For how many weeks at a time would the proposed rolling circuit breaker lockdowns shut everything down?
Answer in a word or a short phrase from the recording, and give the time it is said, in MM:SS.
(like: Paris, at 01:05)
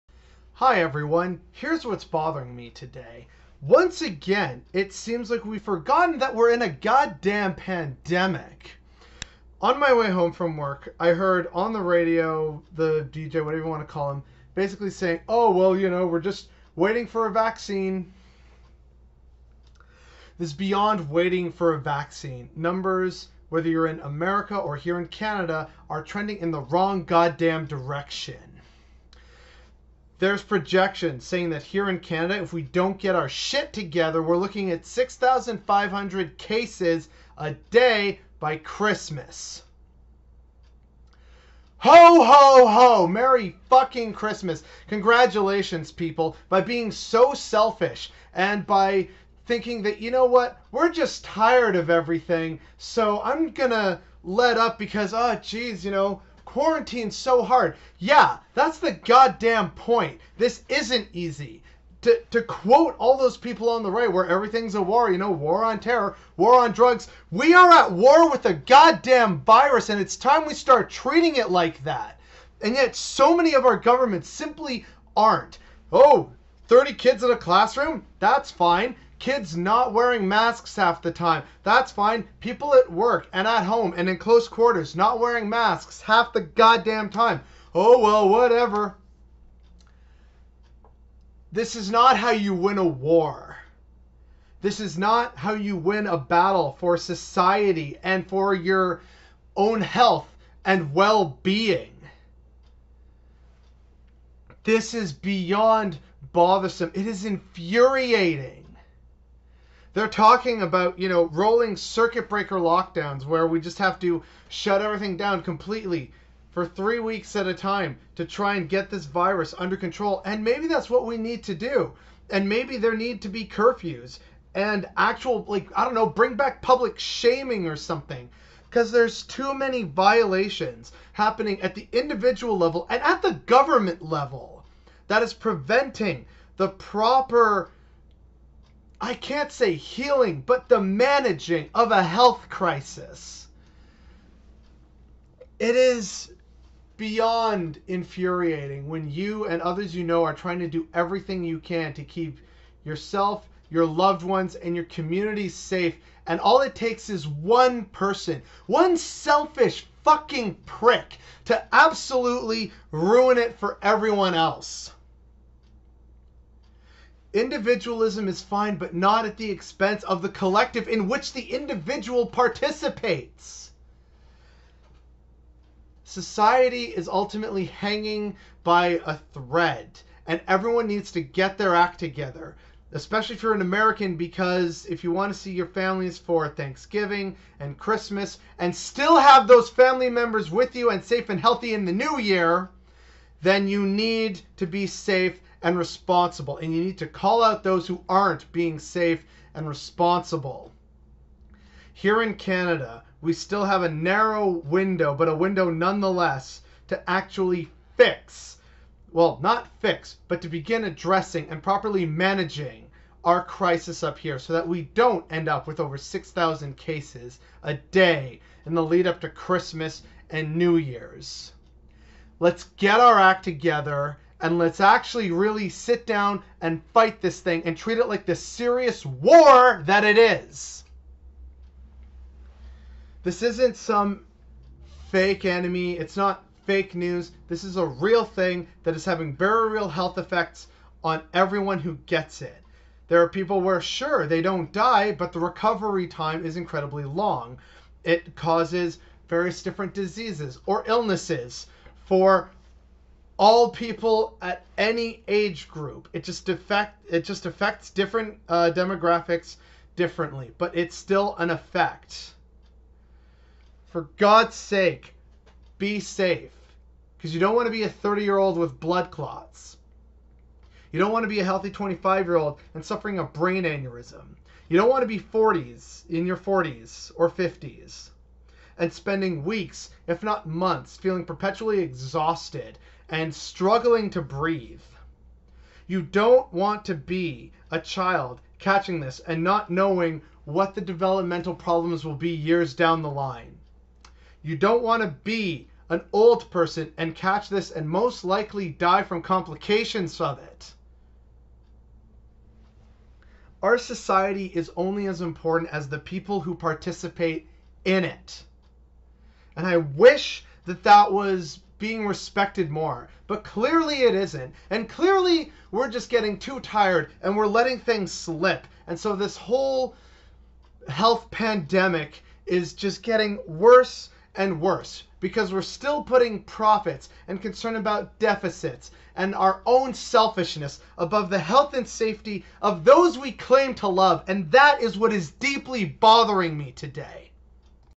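3 weeks, at 01:56.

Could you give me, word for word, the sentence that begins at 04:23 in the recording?
For God's sake, be safe, because you don't want to be a 30 year old with blood clots.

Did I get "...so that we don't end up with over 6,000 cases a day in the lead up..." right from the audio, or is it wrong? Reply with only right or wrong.
right.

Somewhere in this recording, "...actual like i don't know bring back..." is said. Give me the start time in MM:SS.
02:04.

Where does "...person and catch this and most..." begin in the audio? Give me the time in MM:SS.
04:56.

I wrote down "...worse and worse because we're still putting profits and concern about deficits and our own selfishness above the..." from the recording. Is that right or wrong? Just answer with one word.
right.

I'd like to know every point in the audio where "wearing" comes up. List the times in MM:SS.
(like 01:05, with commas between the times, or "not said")
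01:19, 01:25.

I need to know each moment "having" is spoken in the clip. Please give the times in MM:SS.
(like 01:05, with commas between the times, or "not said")
03:59.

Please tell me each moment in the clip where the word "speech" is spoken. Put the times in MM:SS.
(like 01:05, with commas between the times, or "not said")
not said.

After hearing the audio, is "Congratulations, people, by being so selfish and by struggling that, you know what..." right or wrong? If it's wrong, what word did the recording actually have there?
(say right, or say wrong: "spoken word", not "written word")
wrong: "thinking", not "struggling".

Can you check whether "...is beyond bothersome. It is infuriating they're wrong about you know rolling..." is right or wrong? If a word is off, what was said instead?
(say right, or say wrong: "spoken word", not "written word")
wrong: "talking", not "wrong".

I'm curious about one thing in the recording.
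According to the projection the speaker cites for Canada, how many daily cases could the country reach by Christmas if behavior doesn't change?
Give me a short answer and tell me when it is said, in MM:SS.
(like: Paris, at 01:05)
6,500, at 00:34.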